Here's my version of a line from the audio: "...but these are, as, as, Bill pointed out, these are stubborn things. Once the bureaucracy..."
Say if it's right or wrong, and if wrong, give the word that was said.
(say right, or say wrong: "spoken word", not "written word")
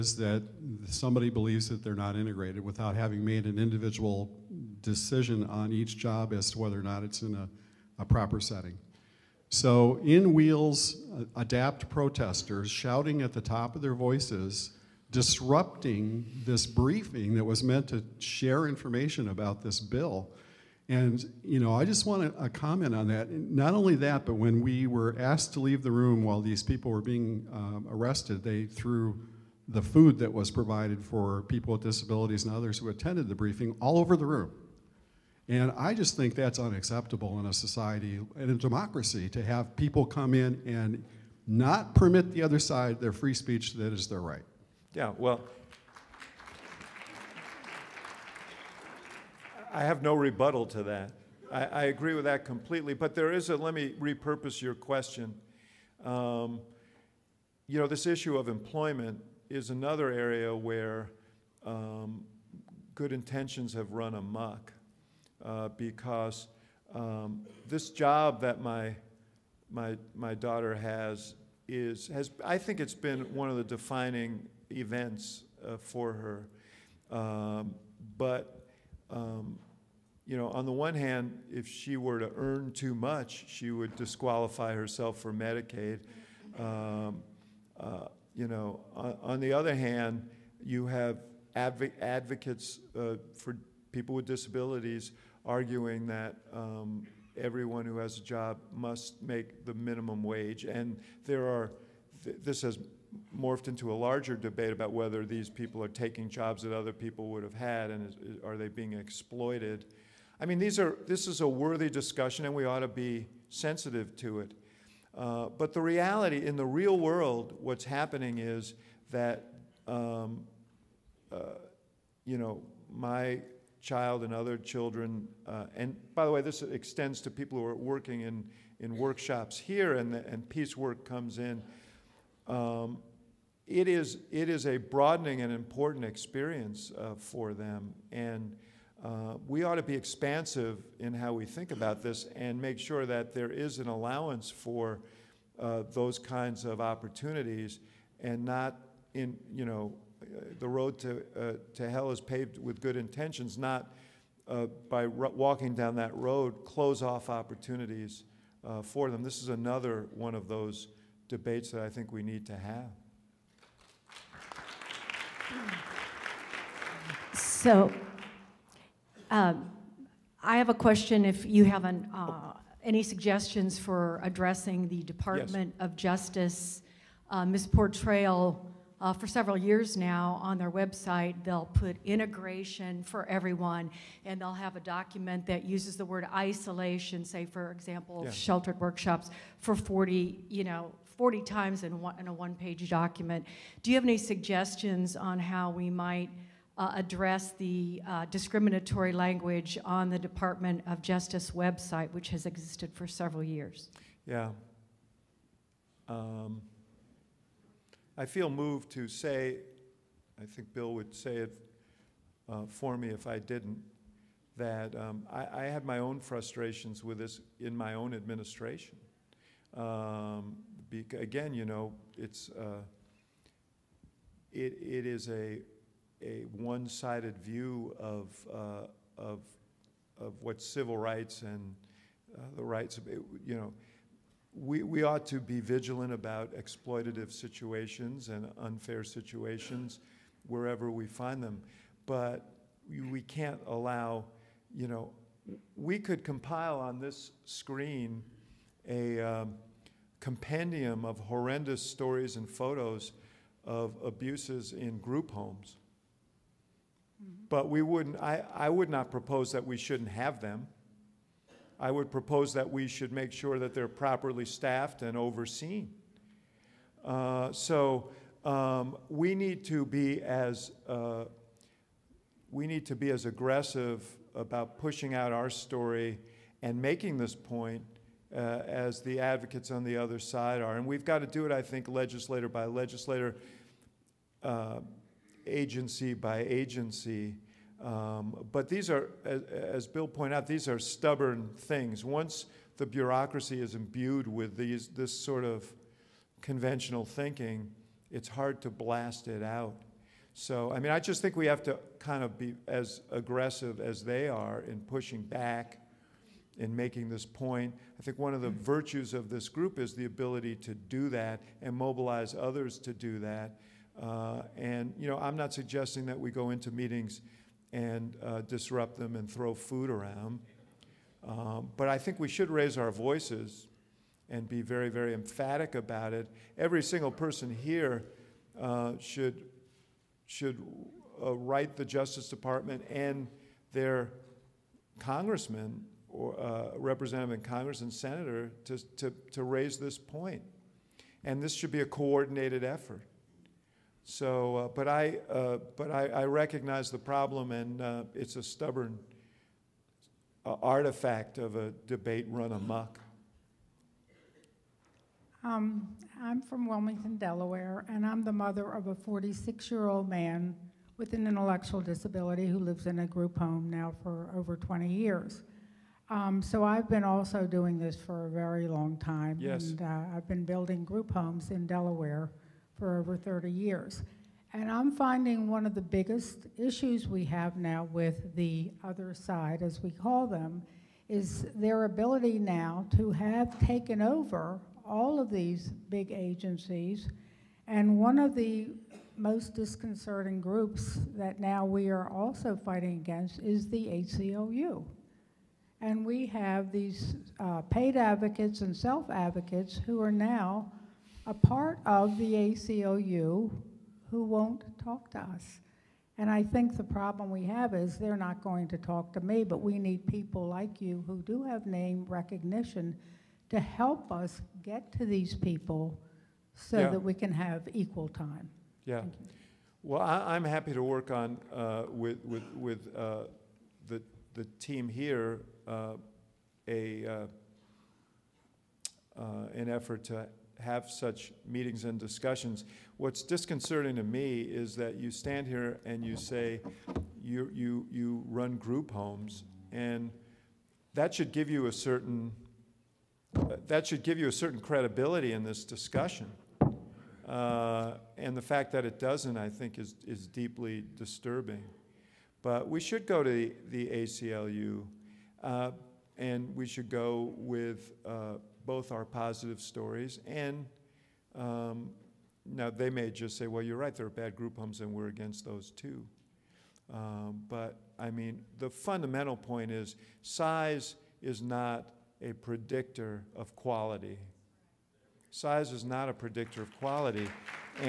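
right.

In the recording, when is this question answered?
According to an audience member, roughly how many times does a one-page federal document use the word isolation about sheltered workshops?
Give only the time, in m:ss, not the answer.
3:11.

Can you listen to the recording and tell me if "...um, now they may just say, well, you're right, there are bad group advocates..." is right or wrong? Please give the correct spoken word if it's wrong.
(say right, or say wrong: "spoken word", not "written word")
wrong: "homes", not "advocates".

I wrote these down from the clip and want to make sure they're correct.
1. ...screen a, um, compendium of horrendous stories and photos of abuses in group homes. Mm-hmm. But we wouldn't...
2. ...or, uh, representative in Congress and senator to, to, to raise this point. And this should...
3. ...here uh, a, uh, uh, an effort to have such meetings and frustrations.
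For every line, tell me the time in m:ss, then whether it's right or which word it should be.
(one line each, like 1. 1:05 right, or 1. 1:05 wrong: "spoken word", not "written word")
1. 4:07 right
2. 5:36 right
3. 7:04 wrong: "discussions", not "frustrations".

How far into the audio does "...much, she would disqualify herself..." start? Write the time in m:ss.
1:22.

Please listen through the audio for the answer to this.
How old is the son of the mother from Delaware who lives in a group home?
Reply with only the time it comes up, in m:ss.
5:58.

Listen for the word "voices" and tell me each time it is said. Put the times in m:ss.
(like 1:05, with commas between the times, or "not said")
0:13, 5:22.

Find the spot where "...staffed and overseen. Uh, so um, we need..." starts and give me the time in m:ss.
4:24.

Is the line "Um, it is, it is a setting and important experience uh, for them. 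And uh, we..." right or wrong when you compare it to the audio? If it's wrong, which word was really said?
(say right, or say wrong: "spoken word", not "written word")
wrong: "broadening", not "setting".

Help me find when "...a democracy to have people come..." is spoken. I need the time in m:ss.
0:38.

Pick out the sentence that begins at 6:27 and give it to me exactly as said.
And one of the most disconcerting groups that now we are also fighting against is the ACLU.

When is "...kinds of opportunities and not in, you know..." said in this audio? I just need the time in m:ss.
2:26.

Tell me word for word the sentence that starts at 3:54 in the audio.
We, we ought to be vigilant about exploitative situations and unfair situations wherever we find them.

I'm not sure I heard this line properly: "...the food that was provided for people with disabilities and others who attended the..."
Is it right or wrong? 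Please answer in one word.
right.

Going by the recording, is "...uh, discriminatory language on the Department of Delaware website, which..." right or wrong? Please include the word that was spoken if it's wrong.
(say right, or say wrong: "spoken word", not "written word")
wrong: "Justice", not "Delaware".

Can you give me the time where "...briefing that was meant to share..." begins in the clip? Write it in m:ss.
0:16.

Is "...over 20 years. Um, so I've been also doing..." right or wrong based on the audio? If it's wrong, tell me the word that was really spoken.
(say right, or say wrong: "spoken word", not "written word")
right.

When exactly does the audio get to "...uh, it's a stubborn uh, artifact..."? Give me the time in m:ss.
5:47.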